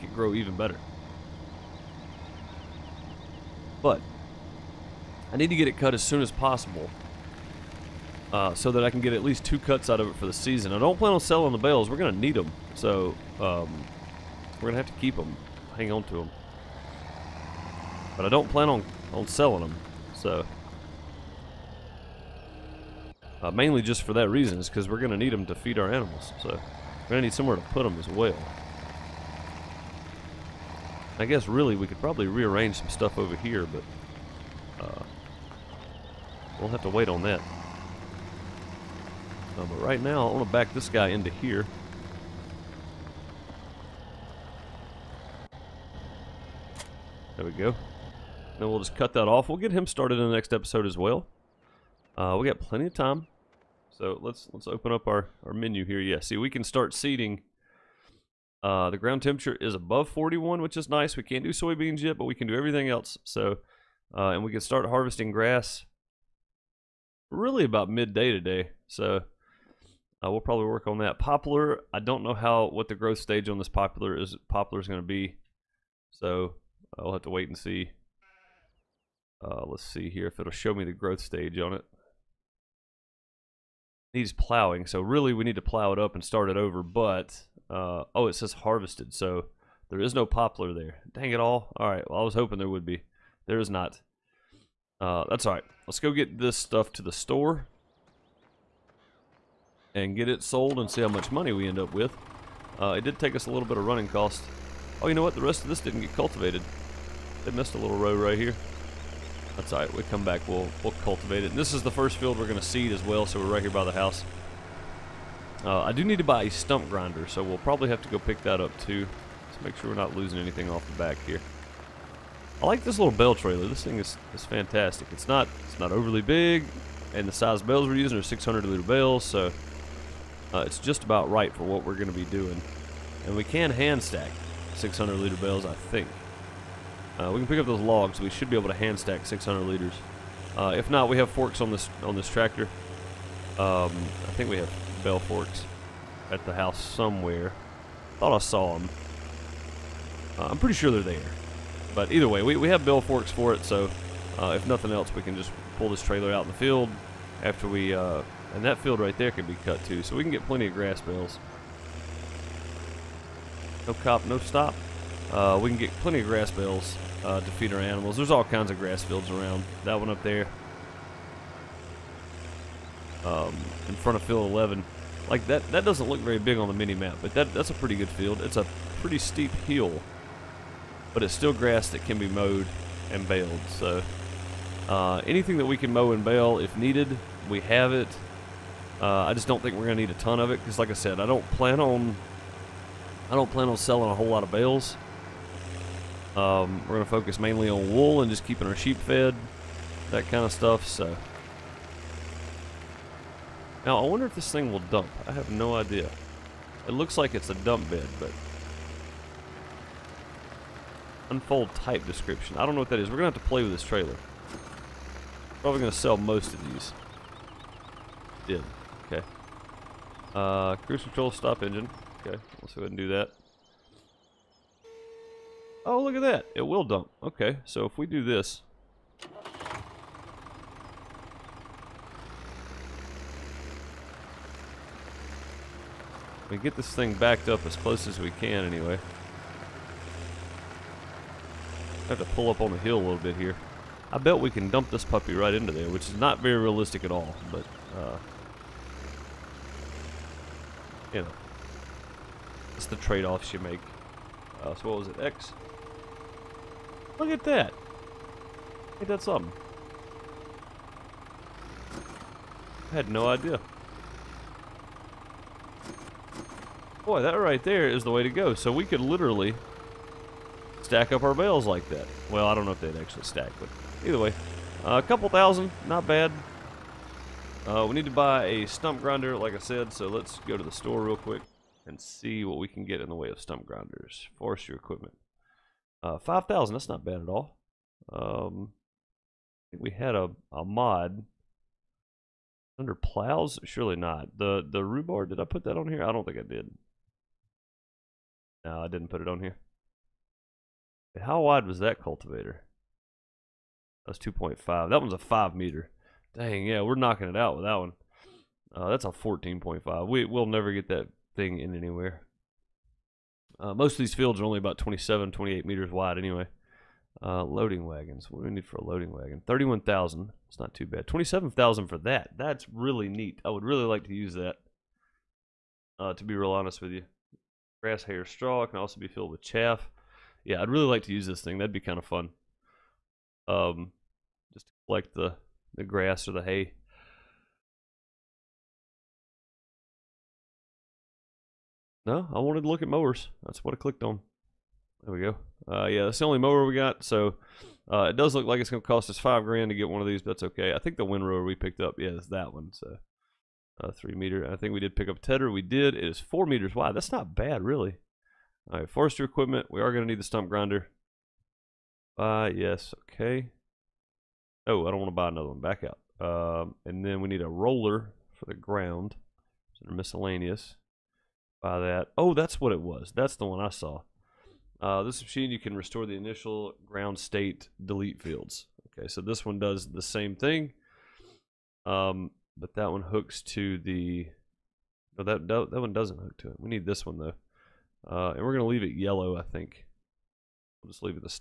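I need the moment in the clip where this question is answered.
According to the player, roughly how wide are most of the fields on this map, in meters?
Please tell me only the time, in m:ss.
5:14.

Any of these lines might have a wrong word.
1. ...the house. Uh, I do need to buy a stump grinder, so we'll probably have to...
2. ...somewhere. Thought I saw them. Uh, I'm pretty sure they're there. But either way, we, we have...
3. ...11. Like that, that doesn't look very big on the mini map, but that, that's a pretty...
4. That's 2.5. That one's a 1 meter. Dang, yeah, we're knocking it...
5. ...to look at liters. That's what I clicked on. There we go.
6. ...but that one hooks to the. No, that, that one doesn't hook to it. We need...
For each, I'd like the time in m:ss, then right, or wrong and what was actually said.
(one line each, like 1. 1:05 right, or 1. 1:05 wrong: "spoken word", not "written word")
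1. 1:53 right
2. 2:26 right
3. 2:54 right
4. 5:04 wrong: "5", not "1"
5. 5:42 wrong: "mowers", not "liters"
6. 6:22 right.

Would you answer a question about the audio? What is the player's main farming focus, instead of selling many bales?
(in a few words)
wool.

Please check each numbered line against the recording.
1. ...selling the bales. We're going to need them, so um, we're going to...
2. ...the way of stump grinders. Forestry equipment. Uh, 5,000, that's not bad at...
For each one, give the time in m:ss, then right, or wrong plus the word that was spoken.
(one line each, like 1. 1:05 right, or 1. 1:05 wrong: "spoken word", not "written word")
1. 0:11 right
2. 4:43 right.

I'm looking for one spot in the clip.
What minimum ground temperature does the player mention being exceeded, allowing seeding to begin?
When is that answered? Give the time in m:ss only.
1:00.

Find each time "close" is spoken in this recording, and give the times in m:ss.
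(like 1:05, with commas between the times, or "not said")
3:57.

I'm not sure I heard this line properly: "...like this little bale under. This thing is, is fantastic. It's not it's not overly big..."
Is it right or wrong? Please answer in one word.
wrong.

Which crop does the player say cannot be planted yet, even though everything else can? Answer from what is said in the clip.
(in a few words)
soybeans.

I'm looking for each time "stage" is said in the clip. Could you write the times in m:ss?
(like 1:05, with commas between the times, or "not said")
1:13, 1:21.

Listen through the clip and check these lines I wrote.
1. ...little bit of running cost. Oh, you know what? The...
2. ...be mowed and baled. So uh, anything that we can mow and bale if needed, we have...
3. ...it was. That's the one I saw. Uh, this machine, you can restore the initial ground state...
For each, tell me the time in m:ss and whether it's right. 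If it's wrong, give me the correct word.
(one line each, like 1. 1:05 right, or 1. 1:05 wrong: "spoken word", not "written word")
1. 1:43 right
2. 3:02 right
3. 6:12 right.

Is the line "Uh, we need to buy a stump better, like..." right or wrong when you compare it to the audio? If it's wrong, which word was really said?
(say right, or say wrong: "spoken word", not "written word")
wrong: "grinder", not "better".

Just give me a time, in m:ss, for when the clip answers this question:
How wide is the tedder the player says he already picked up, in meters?
5:56.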